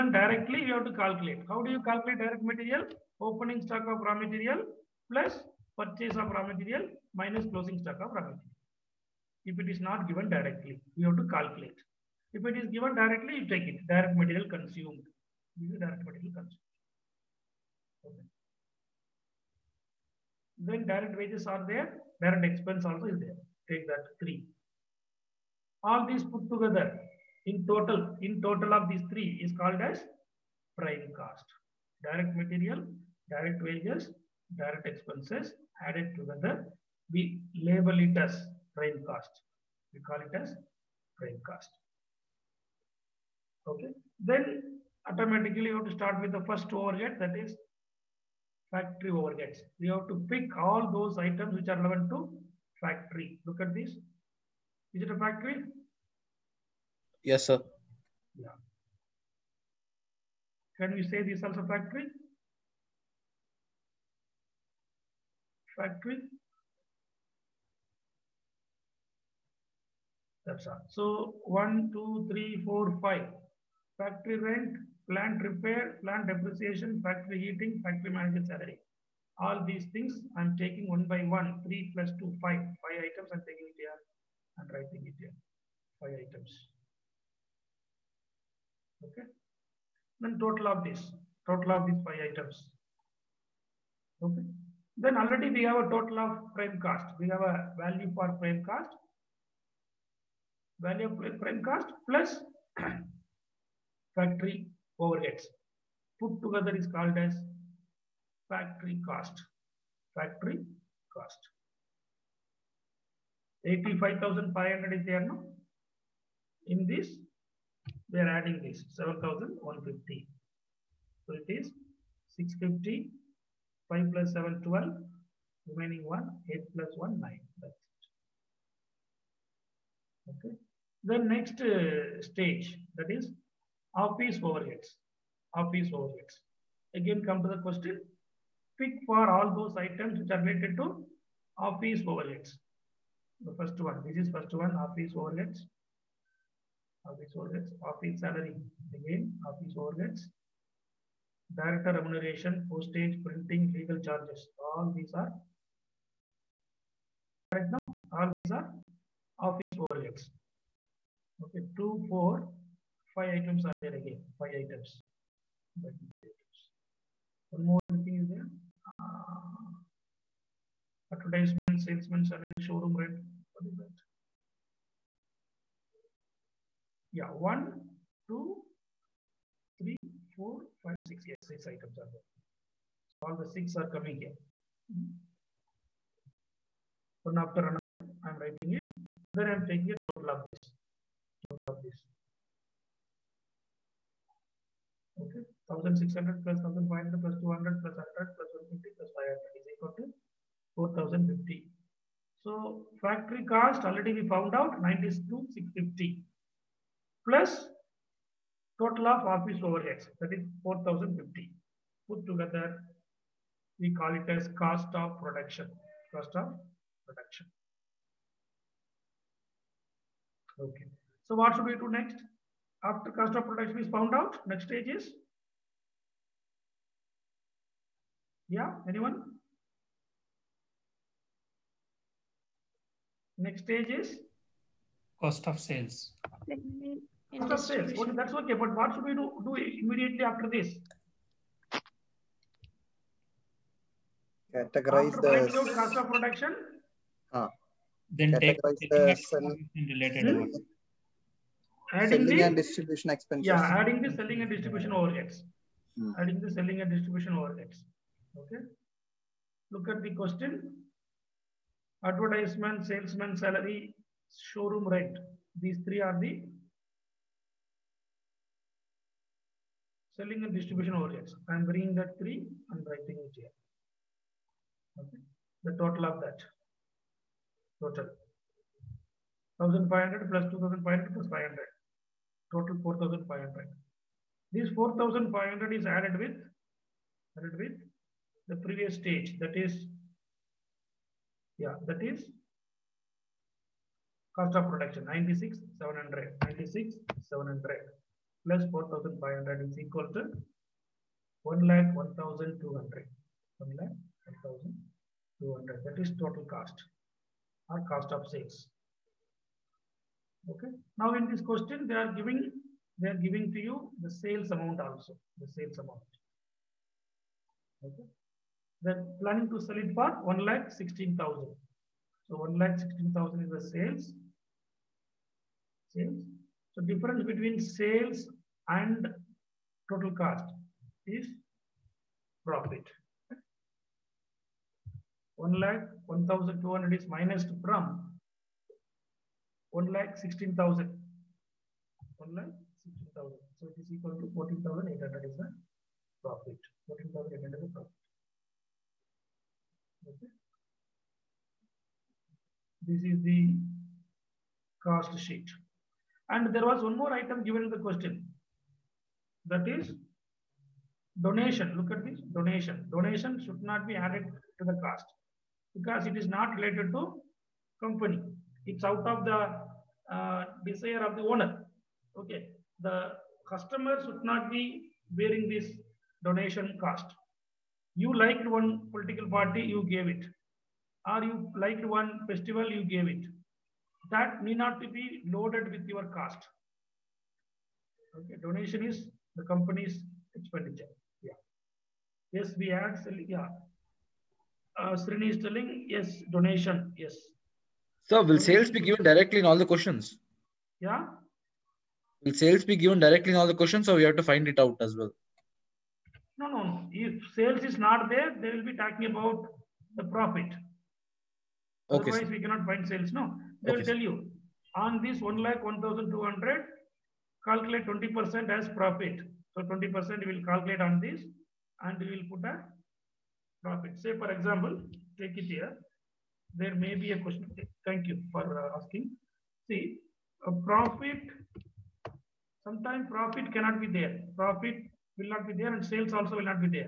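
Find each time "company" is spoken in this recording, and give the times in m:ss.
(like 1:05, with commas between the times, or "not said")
6:07, 6:29.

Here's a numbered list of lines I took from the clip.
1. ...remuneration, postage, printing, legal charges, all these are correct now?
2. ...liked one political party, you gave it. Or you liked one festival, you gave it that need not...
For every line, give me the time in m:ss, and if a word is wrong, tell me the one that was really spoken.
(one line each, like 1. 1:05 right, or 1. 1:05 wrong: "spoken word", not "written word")
1. 2:31 right
2. 6:18 right.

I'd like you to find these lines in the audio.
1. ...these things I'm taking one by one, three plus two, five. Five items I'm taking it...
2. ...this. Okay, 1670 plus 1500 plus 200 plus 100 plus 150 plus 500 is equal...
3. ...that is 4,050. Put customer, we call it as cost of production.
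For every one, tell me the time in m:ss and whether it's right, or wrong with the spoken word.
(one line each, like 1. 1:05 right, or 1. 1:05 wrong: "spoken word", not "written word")
1. 1:19 right
2. 3:11 wrong: "1600", not "1670"
3. 3:30 wrong: "together", not "customer".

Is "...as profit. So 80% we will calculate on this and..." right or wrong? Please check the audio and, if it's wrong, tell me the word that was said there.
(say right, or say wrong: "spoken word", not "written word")
wrong: "20", not "80".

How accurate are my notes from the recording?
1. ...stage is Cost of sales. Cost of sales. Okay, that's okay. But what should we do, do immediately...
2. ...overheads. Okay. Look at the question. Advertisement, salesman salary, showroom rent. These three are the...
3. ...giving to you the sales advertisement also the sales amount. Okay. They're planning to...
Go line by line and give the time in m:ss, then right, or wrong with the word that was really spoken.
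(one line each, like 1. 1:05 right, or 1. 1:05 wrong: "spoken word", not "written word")
1. 3:53 right
2. 4:17 right
3. 5:13 wrong: "amount", not "advertisement".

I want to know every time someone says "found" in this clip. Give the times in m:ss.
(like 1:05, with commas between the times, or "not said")
3:24, 3:43.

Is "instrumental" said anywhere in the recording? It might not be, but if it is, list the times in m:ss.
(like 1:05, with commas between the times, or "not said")
not said.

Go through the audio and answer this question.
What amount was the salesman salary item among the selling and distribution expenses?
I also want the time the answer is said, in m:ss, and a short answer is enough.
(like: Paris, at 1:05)
2500, at 4:40.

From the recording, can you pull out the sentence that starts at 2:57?
yeah, one, two, three, four, five, six.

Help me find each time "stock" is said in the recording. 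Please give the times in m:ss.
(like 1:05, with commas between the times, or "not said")
0:03, 0:07.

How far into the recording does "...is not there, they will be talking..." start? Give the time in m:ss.
6:47.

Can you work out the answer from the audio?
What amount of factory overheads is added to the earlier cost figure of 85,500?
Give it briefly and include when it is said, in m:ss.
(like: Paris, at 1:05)
7150, at 1:58.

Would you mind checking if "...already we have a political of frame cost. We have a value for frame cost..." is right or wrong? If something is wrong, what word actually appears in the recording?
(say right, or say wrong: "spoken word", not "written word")
wrong: "total", not "political".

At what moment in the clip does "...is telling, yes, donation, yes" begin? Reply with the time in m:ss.
6:35.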